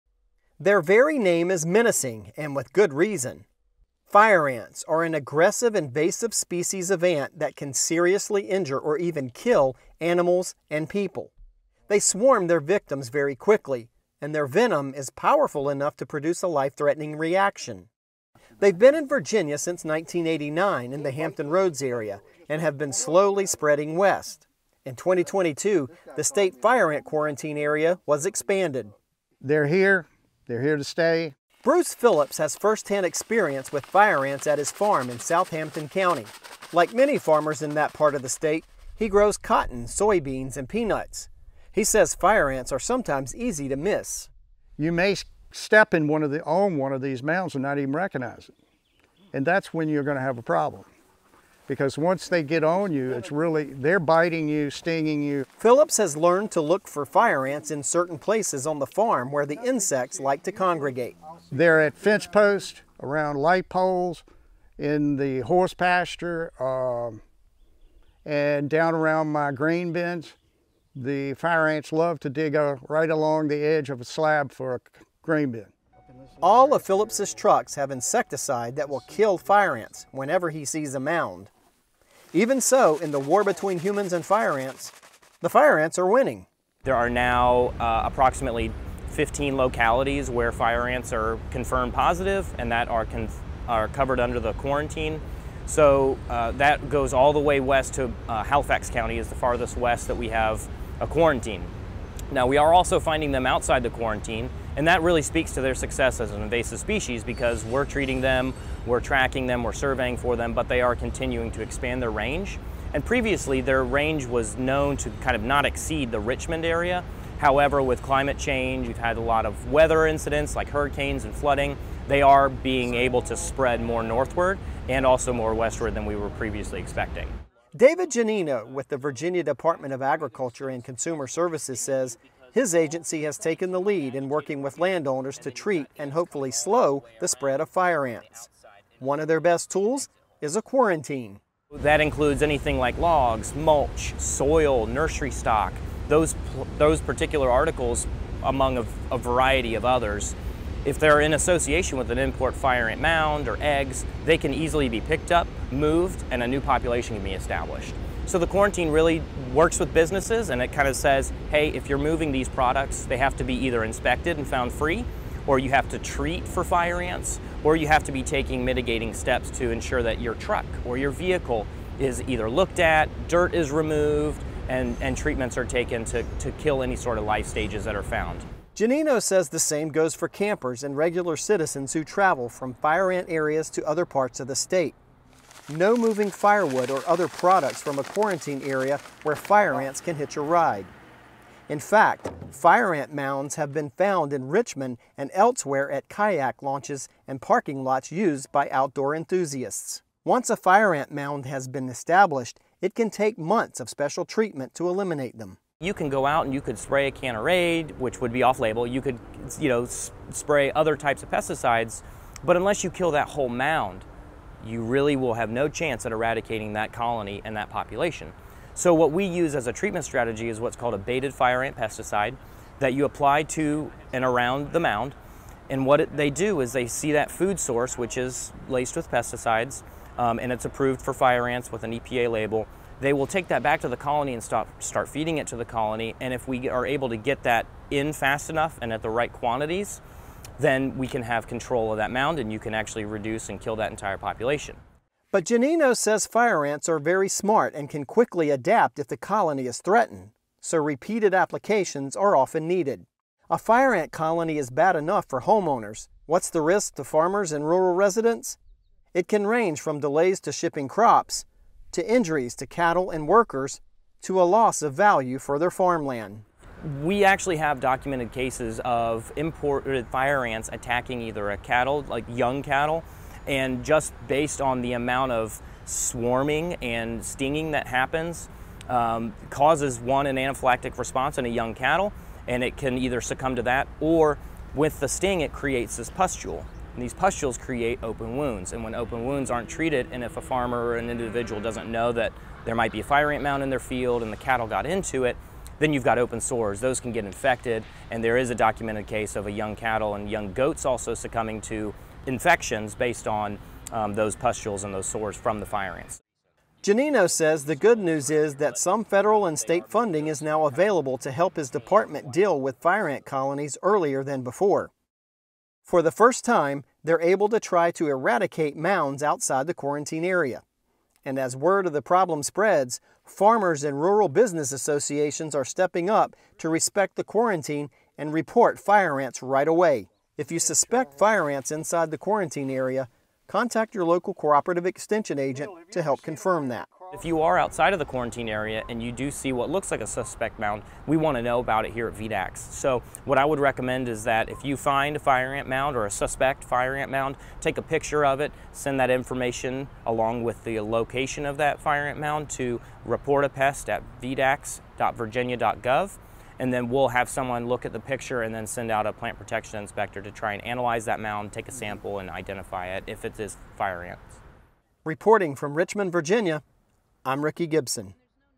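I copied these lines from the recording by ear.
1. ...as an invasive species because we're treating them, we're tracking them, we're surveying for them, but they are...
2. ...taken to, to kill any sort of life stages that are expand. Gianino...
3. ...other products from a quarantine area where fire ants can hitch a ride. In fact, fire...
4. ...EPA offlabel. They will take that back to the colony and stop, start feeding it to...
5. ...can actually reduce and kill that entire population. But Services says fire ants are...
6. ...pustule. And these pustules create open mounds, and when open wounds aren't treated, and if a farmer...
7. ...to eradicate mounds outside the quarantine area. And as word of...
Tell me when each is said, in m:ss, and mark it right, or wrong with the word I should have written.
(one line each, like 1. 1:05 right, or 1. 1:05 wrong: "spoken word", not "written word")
1. 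1:46 right
2. 2:55 wrong: "found", not "expand"
3. 3:07 right
4. 3:51 wrong: "label", not "offlabel"
5. 4:02 wrong: "Gianino", not "Services"
6. 4:46 wrong: "wounds", not "mounds"
7. 5:17 right.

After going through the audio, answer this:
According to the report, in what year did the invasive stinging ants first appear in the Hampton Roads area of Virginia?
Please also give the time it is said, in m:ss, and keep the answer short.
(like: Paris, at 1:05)
1989, at 0:19.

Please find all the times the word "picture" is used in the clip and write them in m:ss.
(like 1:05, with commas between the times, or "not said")
5:47, 5:57.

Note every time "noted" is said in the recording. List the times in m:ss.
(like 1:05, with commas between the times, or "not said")
not said.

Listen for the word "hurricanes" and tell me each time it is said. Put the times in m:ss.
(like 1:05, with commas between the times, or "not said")
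2:00.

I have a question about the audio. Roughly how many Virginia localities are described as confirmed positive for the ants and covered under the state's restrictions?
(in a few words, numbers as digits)
15.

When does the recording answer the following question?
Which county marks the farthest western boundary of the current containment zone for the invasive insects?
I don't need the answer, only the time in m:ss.
1:38.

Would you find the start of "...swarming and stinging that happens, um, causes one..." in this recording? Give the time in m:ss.
4:35.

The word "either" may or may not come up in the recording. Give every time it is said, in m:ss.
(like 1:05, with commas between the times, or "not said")
2:43, 2:52, 4:31, 4:42.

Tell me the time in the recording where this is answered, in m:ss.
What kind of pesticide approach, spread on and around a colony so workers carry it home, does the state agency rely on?
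3:40.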